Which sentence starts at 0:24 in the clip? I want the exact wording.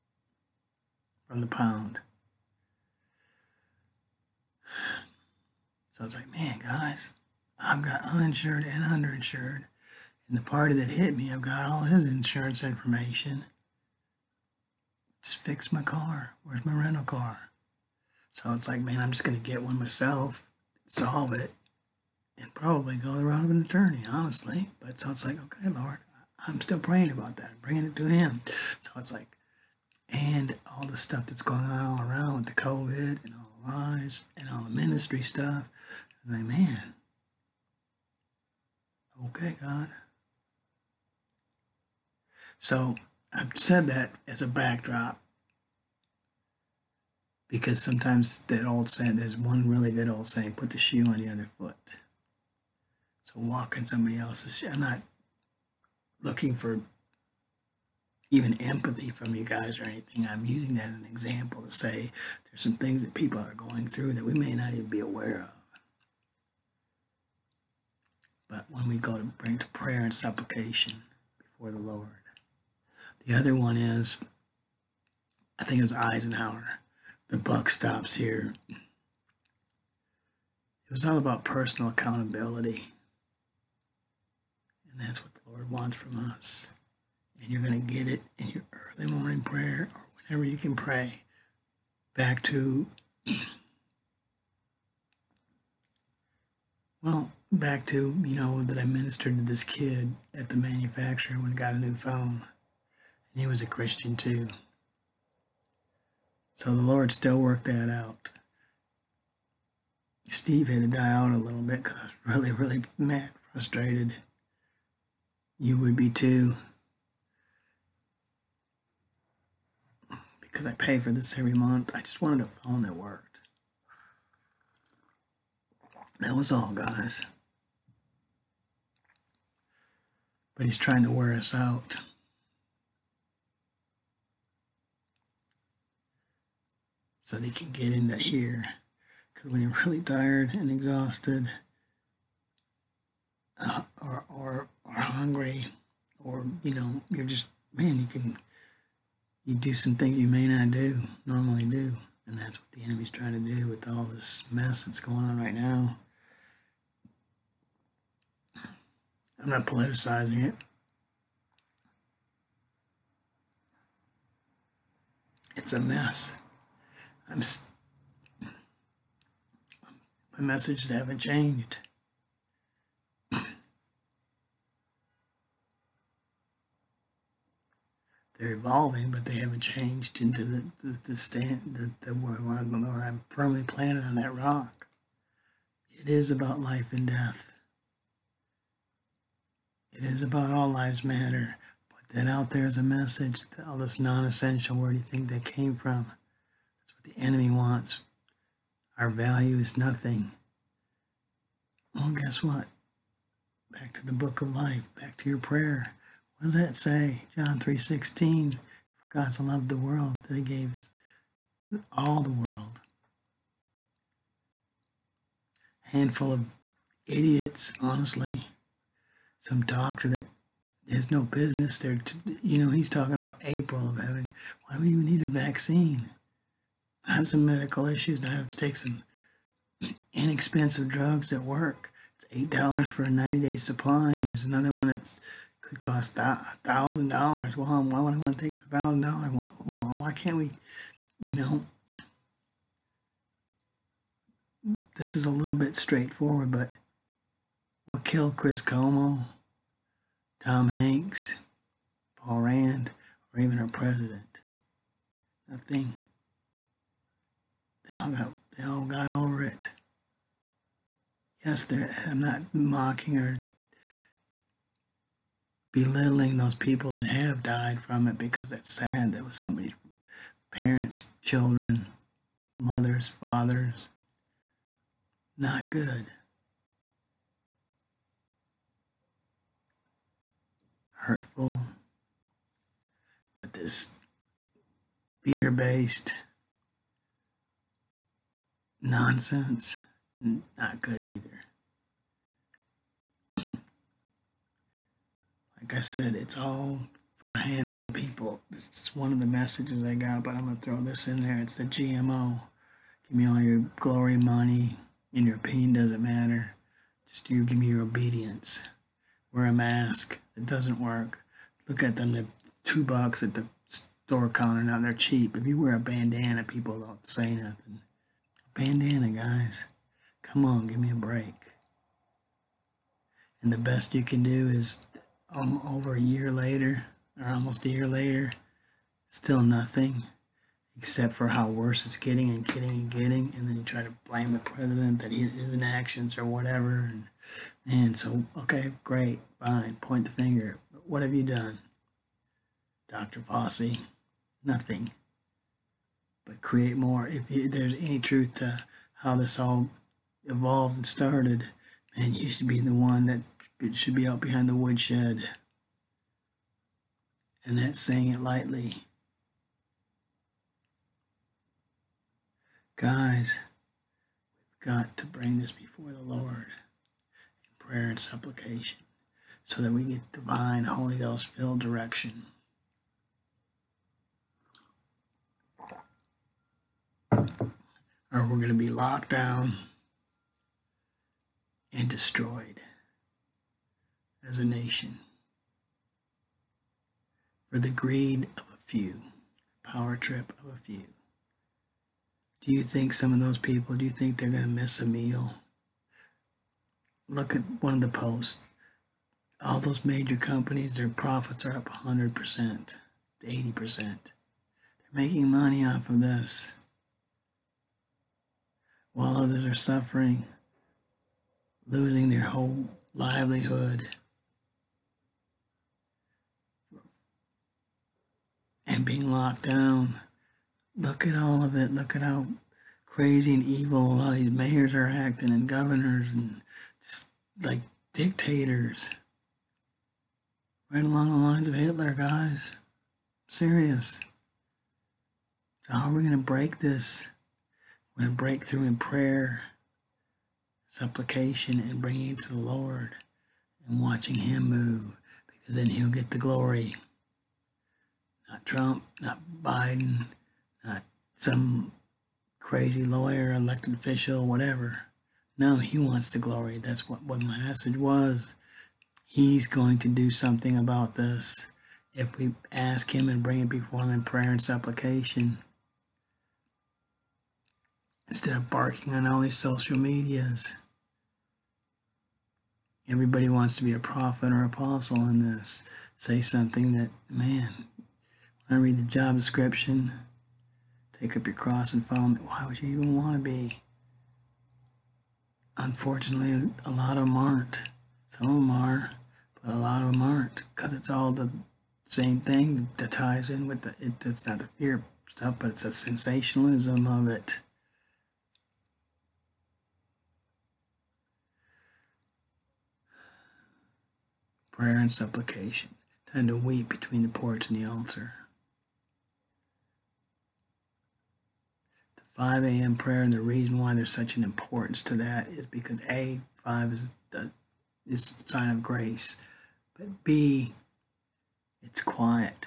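But so it's like, okay, Lord, I'm still praying about that, I'm bringing it to Him.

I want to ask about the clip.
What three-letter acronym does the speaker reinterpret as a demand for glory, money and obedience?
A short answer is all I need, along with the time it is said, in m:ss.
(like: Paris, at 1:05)
GMO, at 5:01.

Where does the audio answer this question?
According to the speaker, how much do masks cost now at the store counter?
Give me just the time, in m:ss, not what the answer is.
5:12.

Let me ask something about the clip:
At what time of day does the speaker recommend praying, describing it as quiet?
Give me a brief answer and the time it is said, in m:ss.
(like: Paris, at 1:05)
5 a.m., at 8:32.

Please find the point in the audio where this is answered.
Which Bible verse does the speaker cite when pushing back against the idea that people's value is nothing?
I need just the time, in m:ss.
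3:27.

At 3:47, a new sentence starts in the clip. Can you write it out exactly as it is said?
I have some medical issues and I have to take some inexpensive drugs that work.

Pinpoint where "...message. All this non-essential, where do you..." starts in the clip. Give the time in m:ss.
3:12.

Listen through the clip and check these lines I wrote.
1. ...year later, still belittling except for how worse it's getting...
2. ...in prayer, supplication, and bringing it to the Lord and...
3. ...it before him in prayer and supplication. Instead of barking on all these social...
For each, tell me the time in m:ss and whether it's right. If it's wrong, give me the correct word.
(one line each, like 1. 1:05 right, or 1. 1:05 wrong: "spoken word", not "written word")
1. 5:27 wrong: "nothing", not "belittling"
2. 7:18 right
3. 7:43 right.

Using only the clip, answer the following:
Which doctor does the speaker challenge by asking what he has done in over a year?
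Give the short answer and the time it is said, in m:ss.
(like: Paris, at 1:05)
Dr. Fauci, at 5:42.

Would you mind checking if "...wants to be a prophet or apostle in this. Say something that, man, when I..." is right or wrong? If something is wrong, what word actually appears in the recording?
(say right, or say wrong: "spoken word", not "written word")
right.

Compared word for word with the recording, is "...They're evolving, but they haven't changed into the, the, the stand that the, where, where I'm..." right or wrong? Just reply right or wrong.
right.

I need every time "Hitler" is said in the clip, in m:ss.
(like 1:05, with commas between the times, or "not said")
7:11.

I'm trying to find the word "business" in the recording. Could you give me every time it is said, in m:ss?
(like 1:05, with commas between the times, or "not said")
3:41.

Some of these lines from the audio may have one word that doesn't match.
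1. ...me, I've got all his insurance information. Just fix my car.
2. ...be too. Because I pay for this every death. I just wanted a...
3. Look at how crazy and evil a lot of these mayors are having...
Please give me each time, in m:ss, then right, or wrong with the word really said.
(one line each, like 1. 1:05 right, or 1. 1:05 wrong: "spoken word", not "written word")
1. 0:11 right
2. 1:55 wrong: "month", not "death"
3. 7:01 wrong: "acting", not "having".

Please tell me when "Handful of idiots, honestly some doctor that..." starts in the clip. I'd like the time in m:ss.
3:35.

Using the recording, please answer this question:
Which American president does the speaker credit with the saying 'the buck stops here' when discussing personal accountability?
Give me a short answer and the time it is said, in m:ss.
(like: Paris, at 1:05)
Eisenhower, at 1:15.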